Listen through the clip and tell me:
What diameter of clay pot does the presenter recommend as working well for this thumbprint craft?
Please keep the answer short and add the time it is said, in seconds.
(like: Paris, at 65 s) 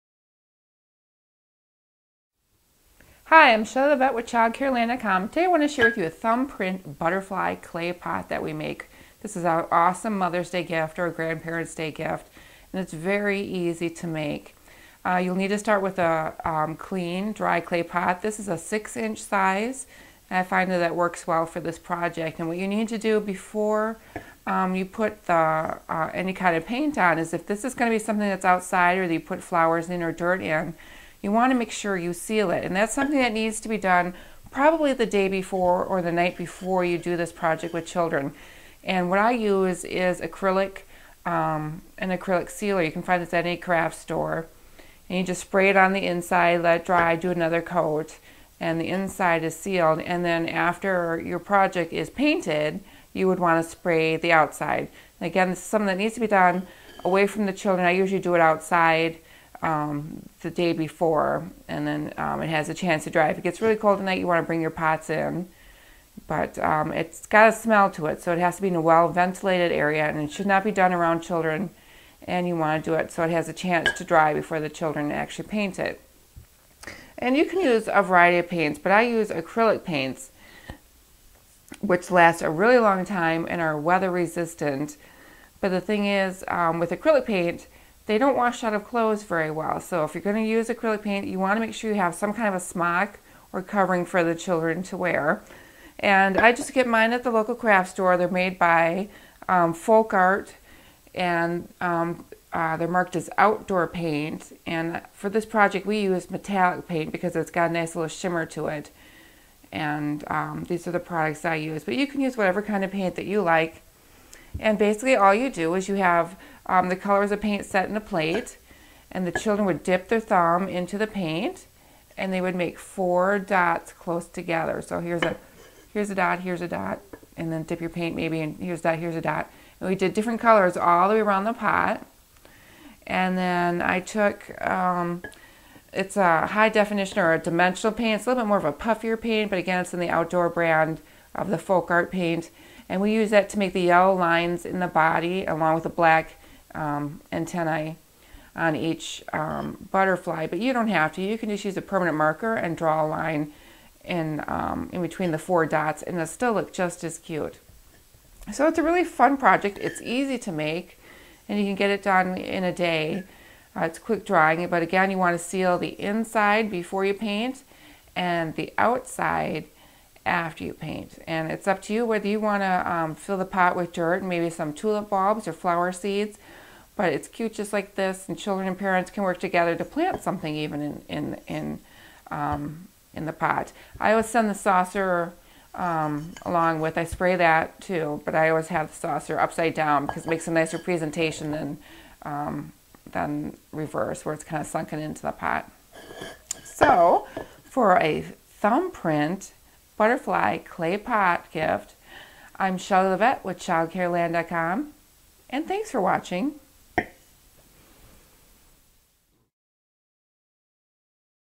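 6 inch, at 18 s.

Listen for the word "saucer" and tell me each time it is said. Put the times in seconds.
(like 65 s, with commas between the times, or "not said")
184 s, 188 s.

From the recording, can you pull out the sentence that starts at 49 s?
And then after your project is painted, you would want to spray the outside.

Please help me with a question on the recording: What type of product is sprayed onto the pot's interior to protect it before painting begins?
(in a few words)
acrylic sealer.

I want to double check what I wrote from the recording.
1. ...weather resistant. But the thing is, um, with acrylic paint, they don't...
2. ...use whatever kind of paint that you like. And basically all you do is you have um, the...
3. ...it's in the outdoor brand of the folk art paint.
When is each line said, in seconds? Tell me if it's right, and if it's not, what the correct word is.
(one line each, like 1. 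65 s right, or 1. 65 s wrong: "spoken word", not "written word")
1. 83 s right
2. 112 s right
3. 139 s right.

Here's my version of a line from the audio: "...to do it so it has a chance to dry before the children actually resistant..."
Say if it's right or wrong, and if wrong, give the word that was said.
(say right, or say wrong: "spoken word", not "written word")
wrong: "paint", not "resistant".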